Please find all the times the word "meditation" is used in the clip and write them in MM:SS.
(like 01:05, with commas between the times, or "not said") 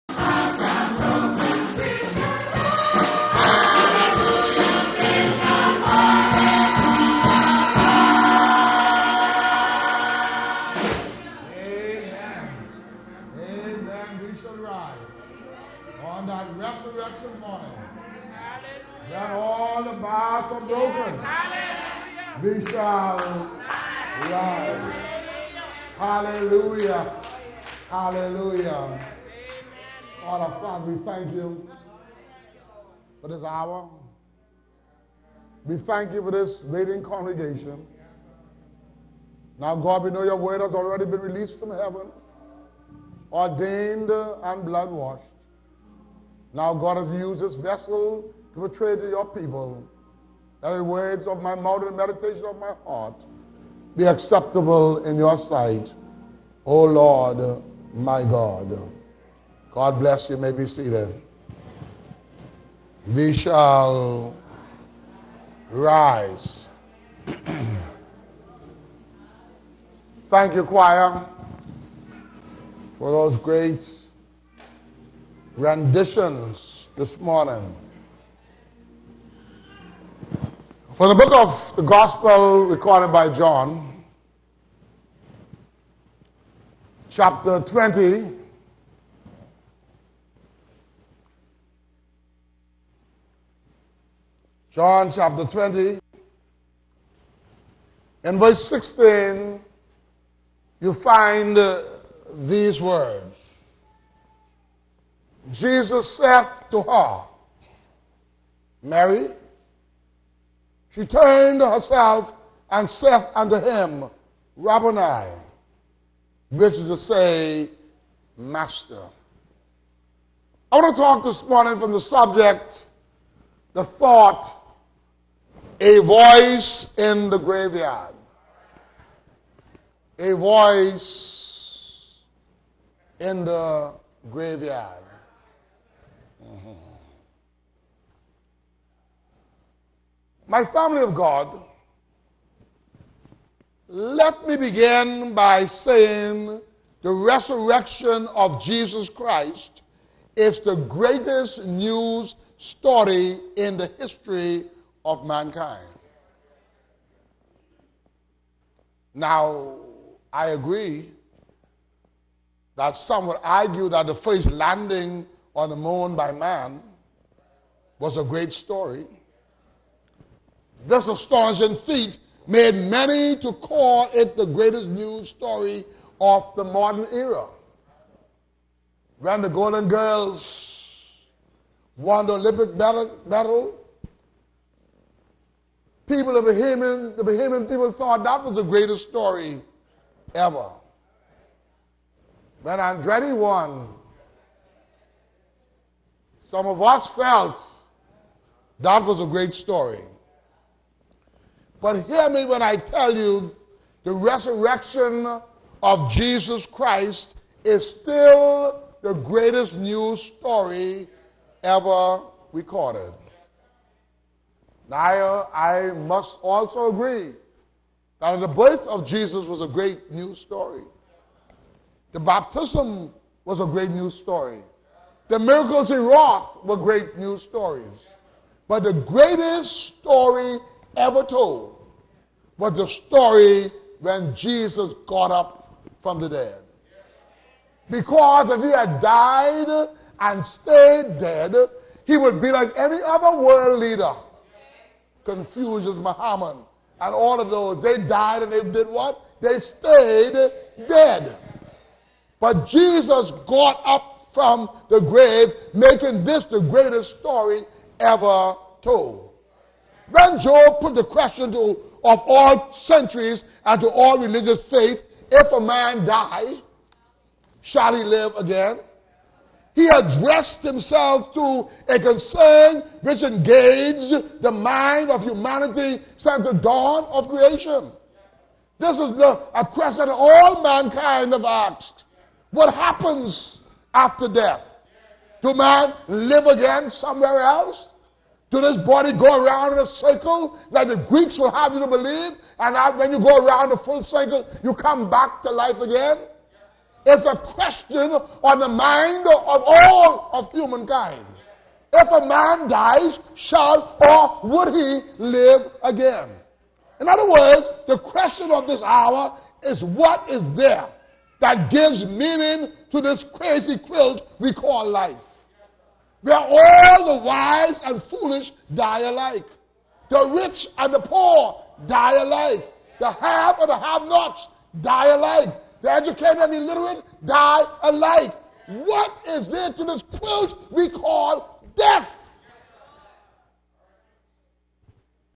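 00:51.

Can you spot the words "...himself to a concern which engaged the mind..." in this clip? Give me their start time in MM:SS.
04:30.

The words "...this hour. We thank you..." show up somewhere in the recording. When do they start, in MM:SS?
00:33.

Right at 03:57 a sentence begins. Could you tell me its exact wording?
Because if he had died and stayed dead, he would be like any other world leader.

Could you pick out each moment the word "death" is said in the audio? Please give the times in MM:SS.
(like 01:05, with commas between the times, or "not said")
04:44, 05:31.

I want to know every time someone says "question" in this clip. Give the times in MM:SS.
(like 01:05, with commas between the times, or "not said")
04:21, 04:39, 04:57, 05:07.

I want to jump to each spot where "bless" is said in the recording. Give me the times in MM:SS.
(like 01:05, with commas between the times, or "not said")
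00:59.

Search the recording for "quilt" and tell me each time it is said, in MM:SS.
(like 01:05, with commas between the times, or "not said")
05:13, 05:30.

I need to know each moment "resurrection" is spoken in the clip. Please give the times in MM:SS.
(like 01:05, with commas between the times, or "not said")
00:16, 02:27, 03:24.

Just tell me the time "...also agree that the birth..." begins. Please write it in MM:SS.
03:36.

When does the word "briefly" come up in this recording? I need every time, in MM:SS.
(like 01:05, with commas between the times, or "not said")
not said.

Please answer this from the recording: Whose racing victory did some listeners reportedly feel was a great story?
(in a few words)
Andretti.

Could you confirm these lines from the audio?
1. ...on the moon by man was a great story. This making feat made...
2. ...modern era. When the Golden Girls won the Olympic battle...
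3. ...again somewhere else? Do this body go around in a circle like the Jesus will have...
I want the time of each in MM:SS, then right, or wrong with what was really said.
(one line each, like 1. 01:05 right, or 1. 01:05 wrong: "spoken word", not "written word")
1. 02:45 wrong: "astonishing", not "making"
2. 02:56 right
3. 04:46 wrong: "Greeks", not "Jesus".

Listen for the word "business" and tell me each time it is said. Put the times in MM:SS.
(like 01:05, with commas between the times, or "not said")
not said.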